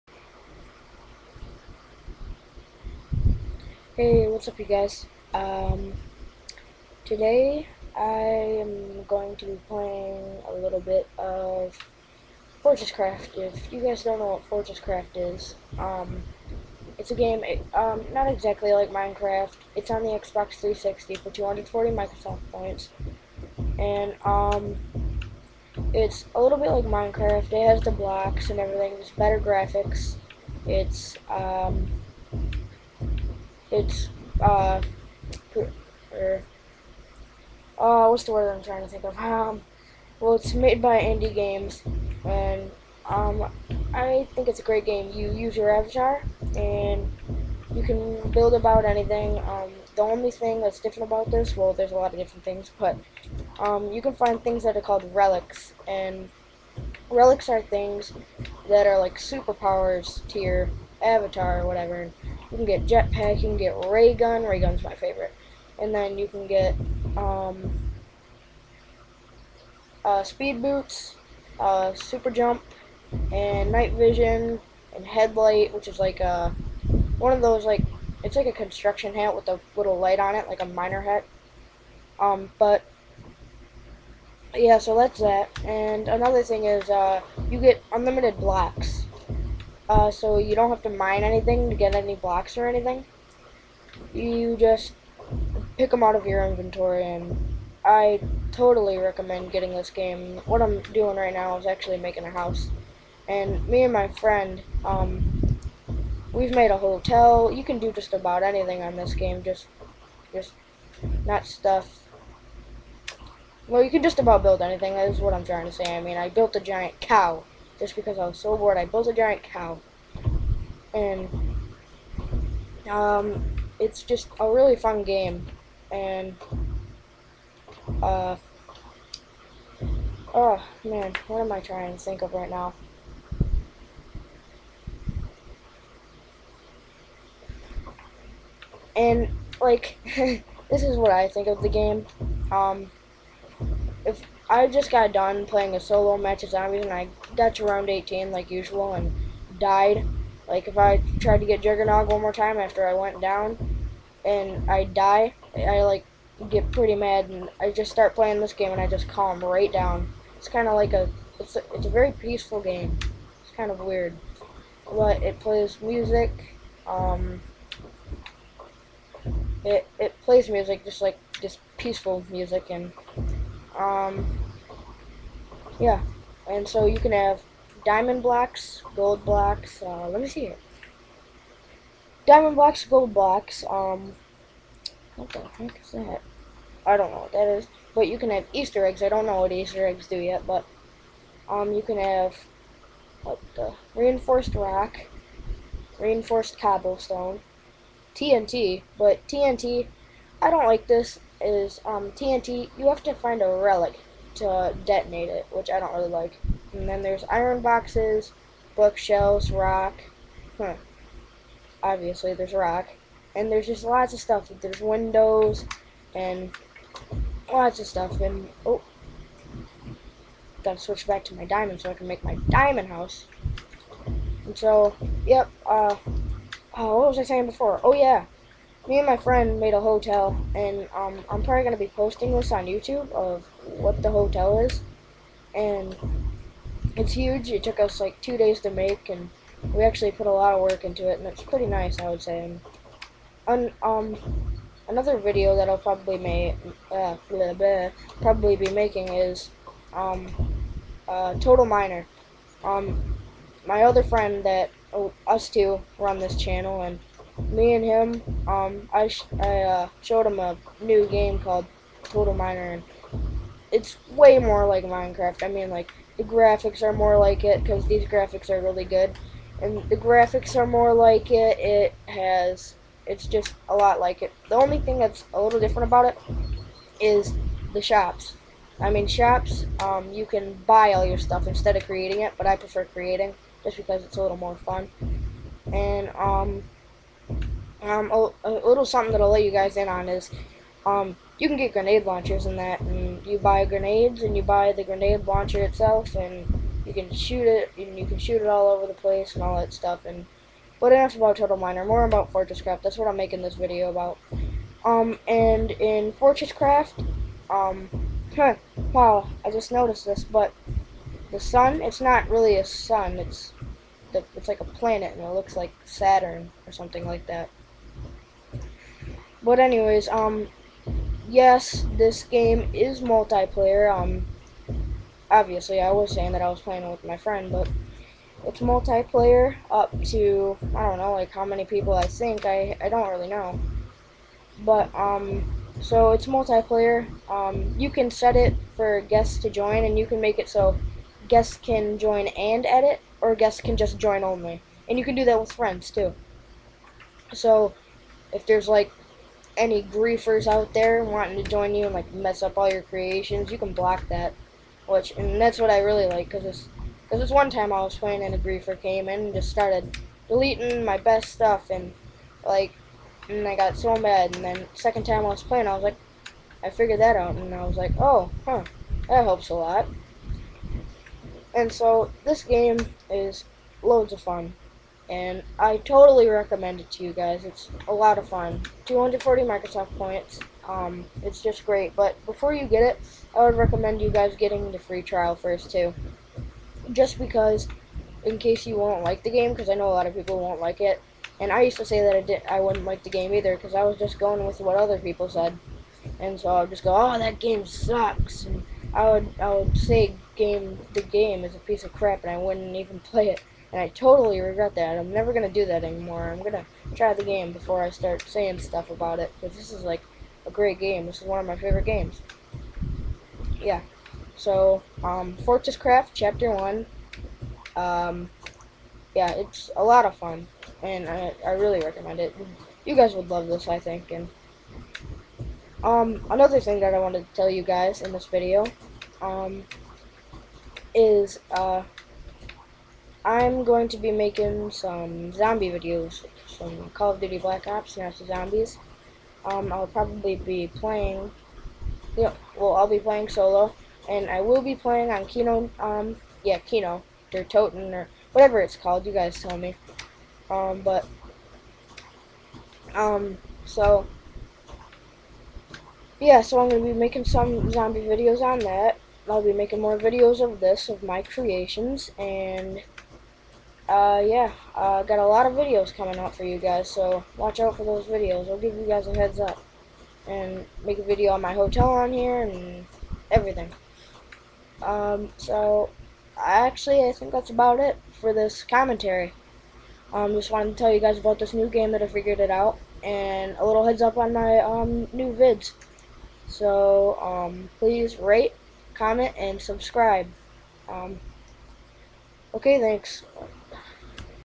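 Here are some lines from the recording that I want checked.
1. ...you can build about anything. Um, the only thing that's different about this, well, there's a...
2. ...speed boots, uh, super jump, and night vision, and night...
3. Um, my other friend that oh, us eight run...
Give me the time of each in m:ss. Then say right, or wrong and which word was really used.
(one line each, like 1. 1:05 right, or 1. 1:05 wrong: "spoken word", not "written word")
1. 0:47 right
2. 1:10 wrong: "headlight", not "night"
3. 4:12 wrong: "two", not "eight".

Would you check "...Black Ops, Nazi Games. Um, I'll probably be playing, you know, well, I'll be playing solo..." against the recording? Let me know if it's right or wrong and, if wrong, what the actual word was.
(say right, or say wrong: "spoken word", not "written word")
wrong: "Zombies", not "Games".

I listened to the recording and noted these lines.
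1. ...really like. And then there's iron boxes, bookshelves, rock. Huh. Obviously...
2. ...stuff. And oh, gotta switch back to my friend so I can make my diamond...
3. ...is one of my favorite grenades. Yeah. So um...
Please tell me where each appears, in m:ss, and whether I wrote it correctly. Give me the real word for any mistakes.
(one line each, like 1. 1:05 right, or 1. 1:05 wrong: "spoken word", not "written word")
1. 3:25 right
2. 3:37 wrong: "diamond", not "friend"
3. 6:51 wrong: "games", not "grenades".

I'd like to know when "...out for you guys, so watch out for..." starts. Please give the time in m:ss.
7:46.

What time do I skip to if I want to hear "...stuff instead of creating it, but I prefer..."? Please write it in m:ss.
4:41.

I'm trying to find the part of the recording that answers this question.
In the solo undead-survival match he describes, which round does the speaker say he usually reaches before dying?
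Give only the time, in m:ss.
2:27.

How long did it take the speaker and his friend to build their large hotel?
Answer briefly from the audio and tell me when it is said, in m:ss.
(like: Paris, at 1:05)
Two days, at 3:58.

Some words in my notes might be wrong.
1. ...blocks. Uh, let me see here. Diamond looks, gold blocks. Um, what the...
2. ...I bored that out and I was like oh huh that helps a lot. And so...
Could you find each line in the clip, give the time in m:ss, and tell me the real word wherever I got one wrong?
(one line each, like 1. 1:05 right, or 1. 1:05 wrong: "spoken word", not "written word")
1. 2:59 wrong: "blocks", not "looks"
2. 6:06 wrong: "figured", not "bored".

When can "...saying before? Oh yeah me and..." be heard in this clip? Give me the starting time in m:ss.
3:47.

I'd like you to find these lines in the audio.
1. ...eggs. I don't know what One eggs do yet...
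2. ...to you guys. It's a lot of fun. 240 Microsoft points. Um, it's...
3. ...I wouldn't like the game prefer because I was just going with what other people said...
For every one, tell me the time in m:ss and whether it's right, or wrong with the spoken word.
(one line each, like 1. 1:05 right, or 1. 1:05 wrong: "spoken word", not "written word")
1. 3:08 wrong: "Easter", not "One"
2. 6:16 right
3. 6:32 wrong: "either", not "prefer".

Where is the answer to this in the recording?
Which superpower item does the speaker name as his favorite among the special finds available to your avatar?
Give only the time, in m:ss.
1:04.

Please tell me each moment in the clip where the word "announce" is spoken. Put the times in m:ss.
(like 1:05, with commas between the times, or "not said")
not said.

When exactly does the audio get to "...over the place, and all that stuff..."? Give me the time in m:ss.
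4:58.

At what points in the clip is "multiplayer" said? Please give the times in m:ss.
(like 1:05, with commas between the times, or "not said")
5:23, 5:28, 5:36.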